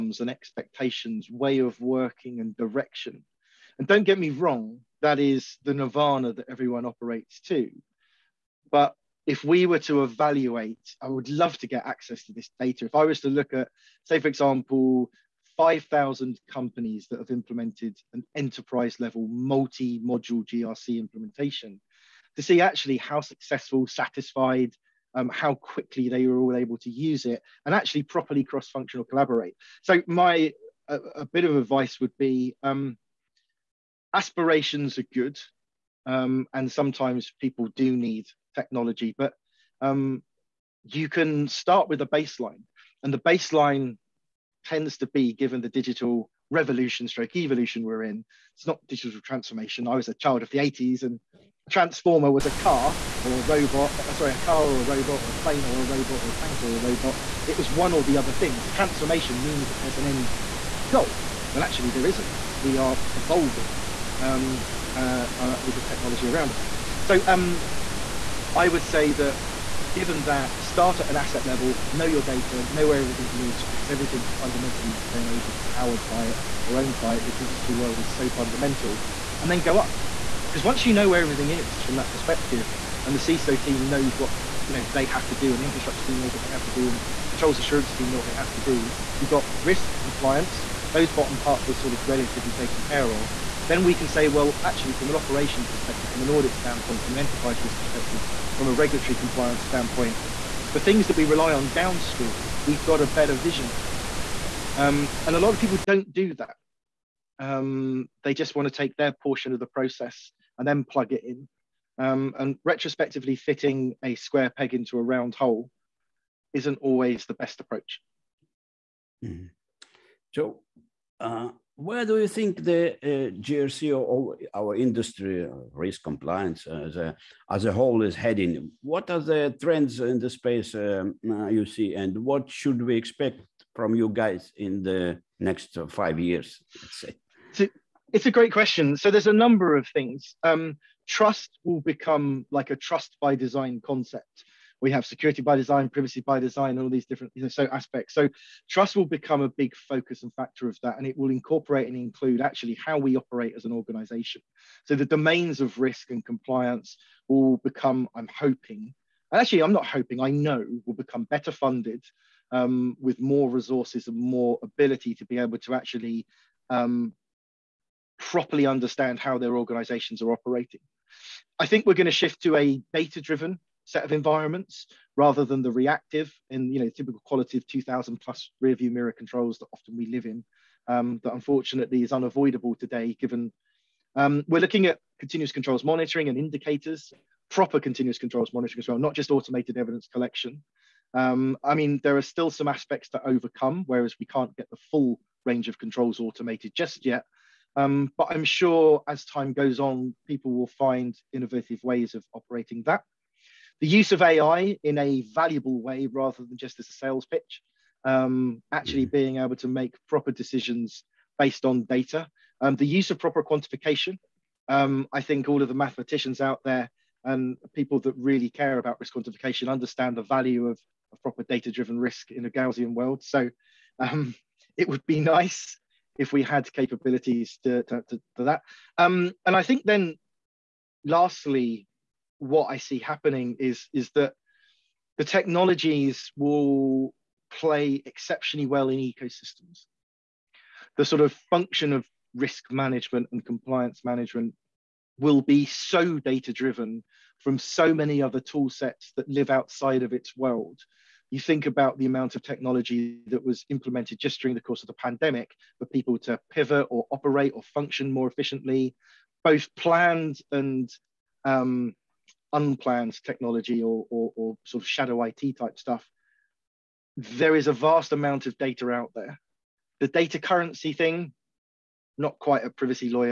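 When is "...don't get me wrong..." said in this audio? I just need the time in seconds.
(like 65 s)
3 s.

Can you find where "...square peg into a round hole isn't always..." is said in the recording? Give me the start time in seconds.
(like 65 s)
114 s.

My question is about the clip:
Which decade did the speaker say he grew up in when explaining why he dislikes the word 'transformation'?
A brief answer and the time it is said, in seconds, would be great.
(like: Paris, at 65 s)
the 80s, at 50 s.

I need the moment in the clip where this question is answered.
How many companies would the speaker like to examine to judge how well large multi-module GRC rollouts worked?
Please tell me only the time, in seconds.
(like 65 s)
15 s.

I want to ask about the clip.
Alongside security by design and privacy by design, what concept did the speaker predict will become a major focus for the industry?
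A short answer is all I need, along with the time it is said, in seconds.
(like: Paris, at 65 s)
trust by design, at 142 s.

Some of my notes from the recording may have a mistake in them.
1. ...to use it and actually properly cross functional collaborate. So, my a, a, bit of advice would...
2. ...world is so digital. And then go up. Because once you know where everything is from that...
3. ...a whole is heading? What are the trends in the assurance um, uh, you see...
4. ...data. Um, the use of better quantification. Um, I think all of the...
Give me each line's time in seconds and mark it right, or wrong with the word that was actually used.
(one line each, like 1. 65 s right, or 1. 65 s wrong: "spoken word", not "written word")
1. 26 s right
2. 77 s wrong: "fundamental", not "digital"
3. 127 s wrong: "space", not "assurance"
4. 211 s wrong: "proper", not "better".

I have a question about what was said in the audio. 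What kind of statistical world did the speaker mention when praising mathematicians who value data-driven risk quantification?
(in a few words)
Gaussian.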